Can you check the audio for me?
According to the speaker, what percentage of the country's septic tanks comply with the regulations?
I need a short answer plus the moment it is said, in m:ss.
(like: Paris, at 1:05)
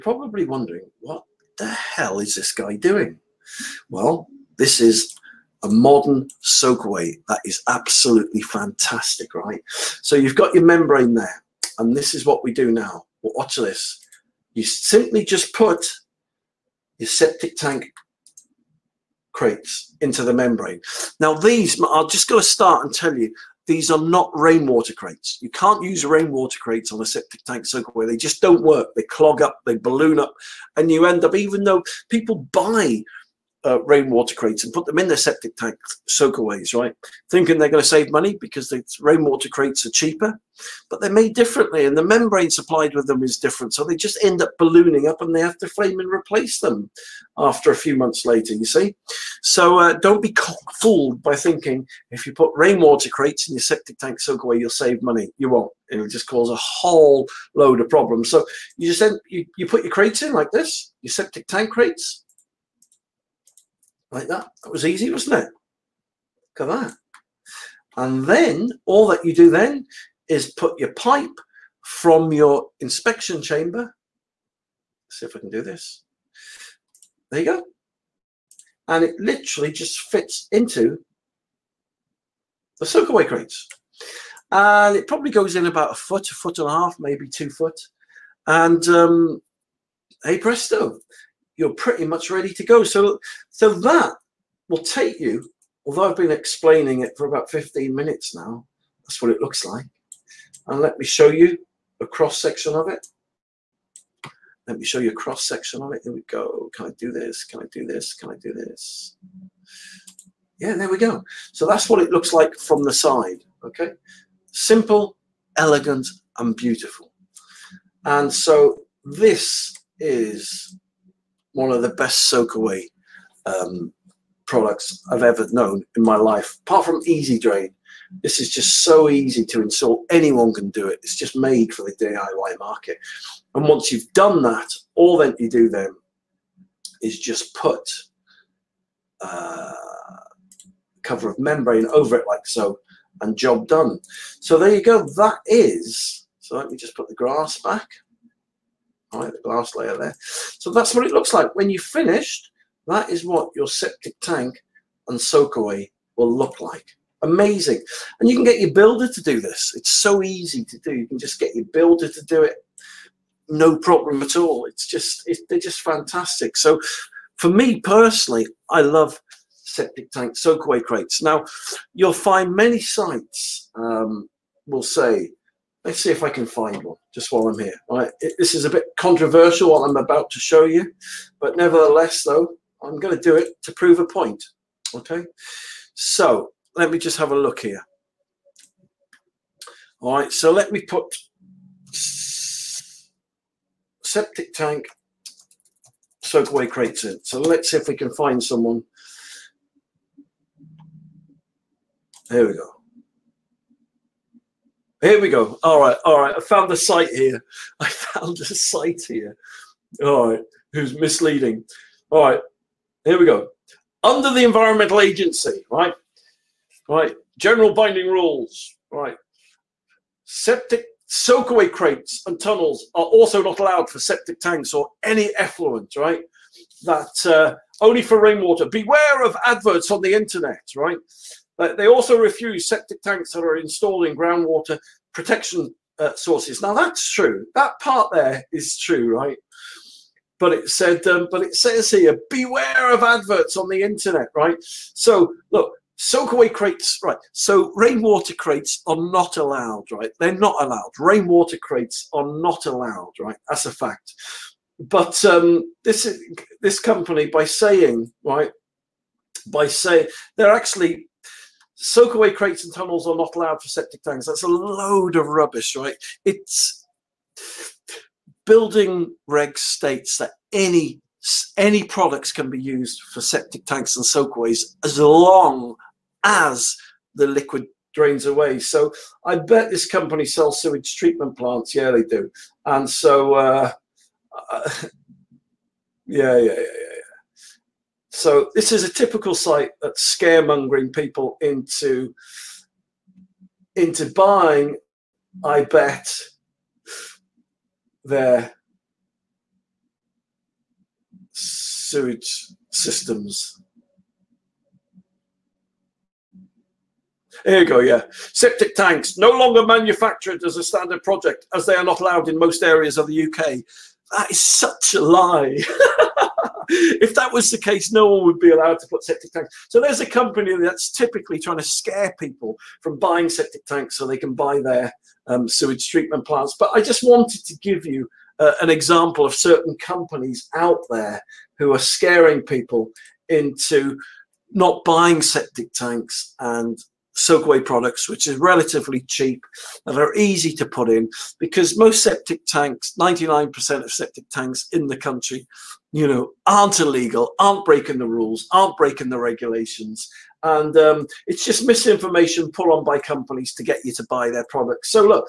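99%, at 5:42.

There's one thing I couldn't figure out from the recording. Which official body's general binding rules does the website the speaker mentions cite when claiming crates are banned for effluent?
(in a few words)
Environmental Agency.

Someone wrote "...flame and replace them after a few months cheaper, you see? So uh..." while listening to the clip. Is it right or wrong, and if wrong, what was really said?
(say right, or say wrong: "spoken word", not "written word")
wrong: "later", not "cheaper".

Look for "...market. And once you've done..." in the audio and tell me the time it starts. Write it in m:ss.
2:12.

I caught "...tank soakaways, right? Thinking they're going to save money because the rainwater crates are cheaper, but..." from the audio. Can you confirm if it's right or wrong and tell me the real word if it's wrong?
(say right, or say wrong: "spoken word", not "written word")
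right.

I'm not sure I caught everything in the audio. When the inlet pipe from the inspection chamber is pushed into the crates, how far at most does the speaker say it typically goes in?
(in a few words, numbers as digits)
2 foot.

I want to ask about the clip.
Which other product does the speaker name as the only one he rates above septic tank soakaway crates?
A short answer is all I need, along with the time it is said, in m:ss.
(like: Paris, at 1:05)
Easy Drain, at 2:07.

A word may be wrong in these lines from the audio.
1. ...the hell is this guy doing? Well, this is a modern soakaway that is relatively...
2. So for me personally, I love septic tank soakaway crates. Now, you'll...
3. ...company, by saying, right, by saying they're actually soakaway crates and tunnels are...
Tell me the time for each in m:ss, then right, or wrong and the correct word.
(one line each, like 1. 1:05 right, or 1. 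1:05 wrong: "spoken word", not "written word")
1. 0:01 wrong: "absolutely", not "relatively"
2. 2:46 right
3. 4:16 right.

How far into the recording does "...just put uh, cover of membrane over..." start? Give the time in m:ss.
2:17.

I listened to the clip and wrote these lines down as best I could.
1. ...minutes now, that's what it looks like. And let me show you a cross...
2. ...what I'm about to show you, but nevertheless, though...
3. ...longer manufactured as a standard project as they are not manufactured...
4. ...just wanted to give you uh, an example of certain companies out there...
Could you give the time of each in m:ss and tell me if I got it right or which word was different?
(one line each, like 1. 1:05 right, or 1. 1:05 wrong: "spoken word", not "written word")
1. 1:37 right
2. 2:59 right
3. 5:09 wrong: "allowed", not "manufactured"
4. 5:26 right.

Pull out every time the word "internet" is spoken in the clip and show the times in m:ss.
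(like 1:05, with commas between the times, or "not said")
3:50, 4:03.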